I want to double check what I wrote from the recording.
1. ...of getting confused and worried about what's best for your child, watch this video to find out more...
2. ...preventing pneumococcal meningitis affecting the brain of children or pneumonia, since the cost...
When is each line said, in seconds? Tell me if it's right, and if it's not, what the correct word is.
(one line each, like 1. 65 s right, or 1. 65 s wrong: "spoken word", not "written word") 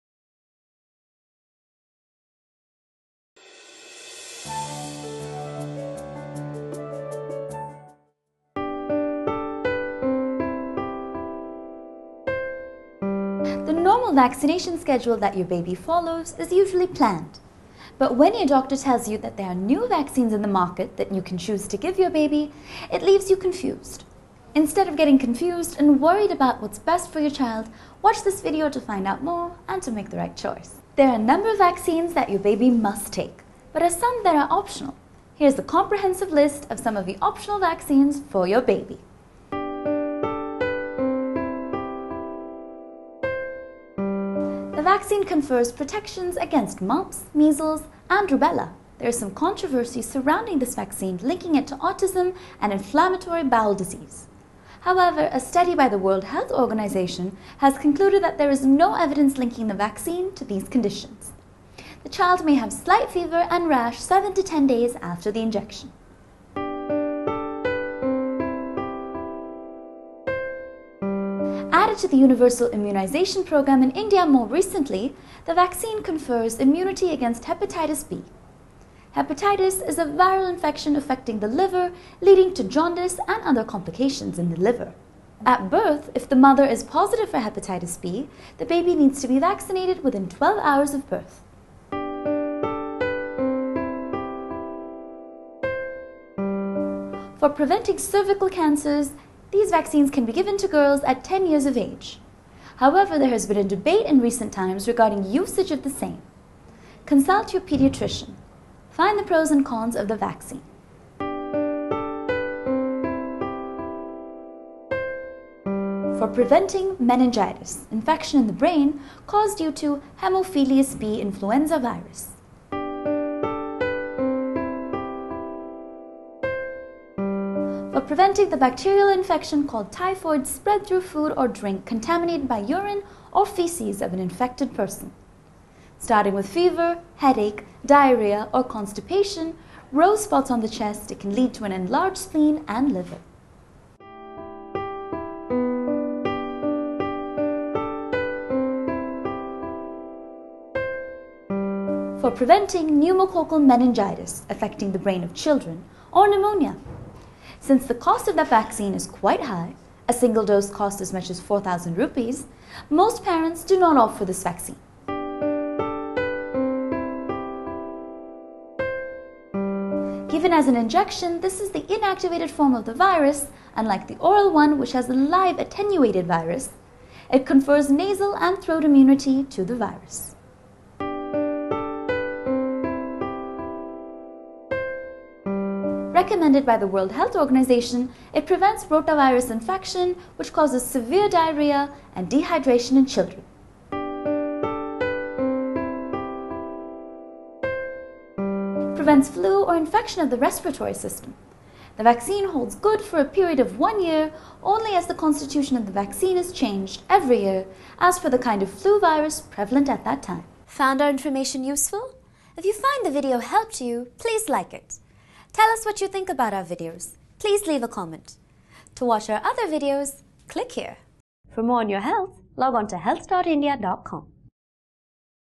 1. 24 s right
2. 152 s right.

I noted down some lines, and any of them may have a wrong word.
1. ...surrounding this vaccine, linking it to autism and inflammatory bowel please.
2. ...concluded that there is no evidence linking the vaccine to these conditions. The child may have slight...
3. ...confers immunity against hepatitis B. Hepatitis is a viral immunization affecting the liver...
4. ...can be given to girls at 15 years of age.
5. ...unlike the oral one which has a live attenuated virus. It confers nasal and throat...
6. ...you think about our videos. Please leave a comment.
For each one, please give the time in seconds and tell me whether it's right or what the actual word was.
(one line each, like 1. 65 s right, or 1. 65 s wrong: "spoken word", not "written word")
1. 50 s wrong: "disease", not "please"
2. 57 s right
3. 76 s wrong: "infection", not "immunization"
4. 100 s wrong: "10", not "15"
5. 173 s right
6. 216 s right.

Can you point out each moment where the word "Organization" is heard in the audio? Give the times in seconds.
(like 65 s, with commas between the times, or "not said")
56 s, 187 s.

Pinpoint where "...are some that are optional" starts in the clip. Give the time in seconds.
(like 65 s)
33 s.